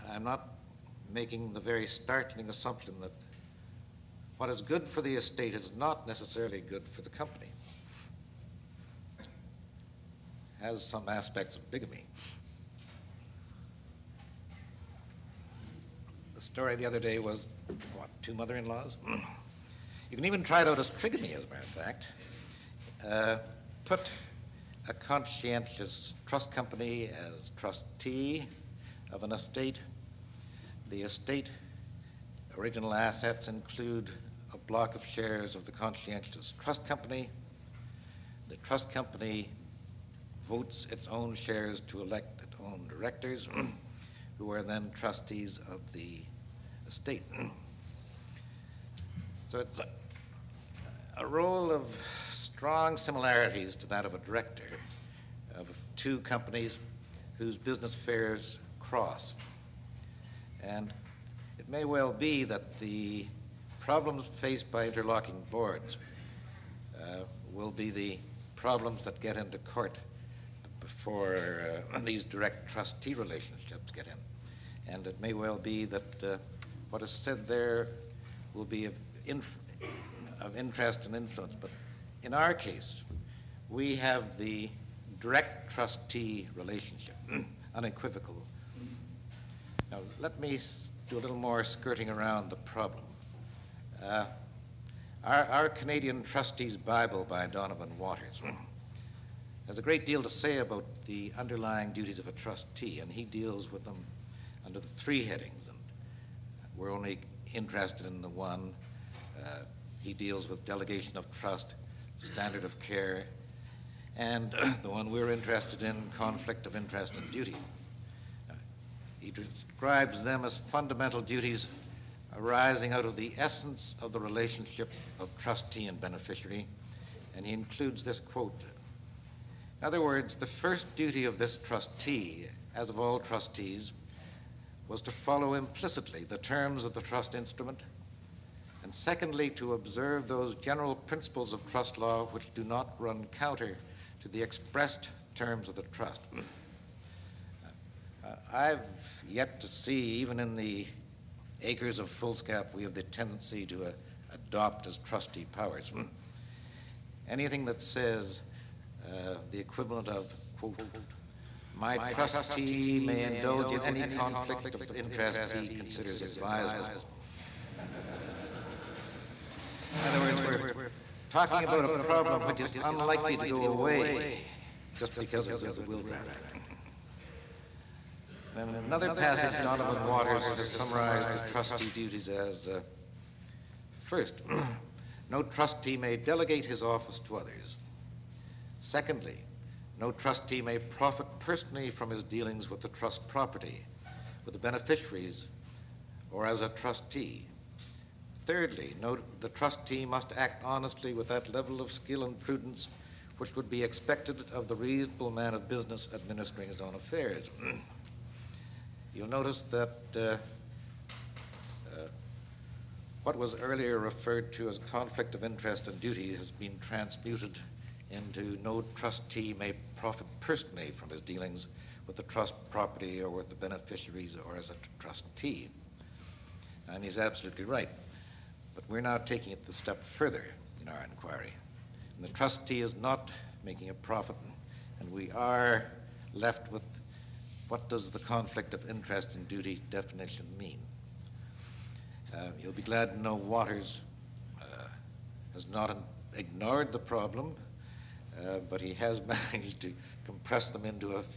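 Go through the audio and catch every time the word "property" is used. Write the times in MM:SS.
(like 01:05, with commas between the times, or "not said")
03:13, 03:42.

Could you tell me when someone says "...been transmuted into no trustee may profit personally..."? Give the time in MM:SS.
03:36.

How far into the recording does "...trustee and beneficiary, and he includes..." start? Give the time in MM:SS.
02:05.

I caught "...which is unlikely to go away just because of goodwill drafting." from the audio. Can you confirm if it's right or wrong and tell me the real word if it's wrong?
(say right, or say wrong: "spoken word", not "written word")
right.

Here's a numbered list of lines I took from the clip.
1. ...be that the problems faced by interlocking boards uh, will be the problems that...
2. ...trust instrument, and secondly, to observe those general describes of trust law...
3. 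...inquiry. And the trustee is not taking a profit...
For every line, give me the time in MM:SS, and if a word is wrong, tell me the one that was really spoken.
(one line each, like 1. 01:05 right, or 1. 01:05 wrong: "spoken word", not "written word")
1. 01:02 right
2. 02:17 wrong: "principles", not "describes"
3. 03:51 wrong: "making", not "taking".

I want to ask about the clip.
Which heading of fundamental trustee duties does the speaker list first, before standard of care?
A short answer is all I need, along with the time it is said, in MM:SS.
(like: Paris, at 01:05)
delegation of trust, at 01:50.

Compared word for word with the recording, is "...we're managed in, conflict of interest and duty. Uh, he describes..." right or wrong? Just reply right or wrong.
wrong.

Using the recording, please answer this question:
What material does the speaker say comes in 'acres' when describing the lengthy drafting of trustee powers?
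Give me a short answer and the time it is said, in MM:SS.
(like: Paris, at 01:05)
foolscap, at 02:32.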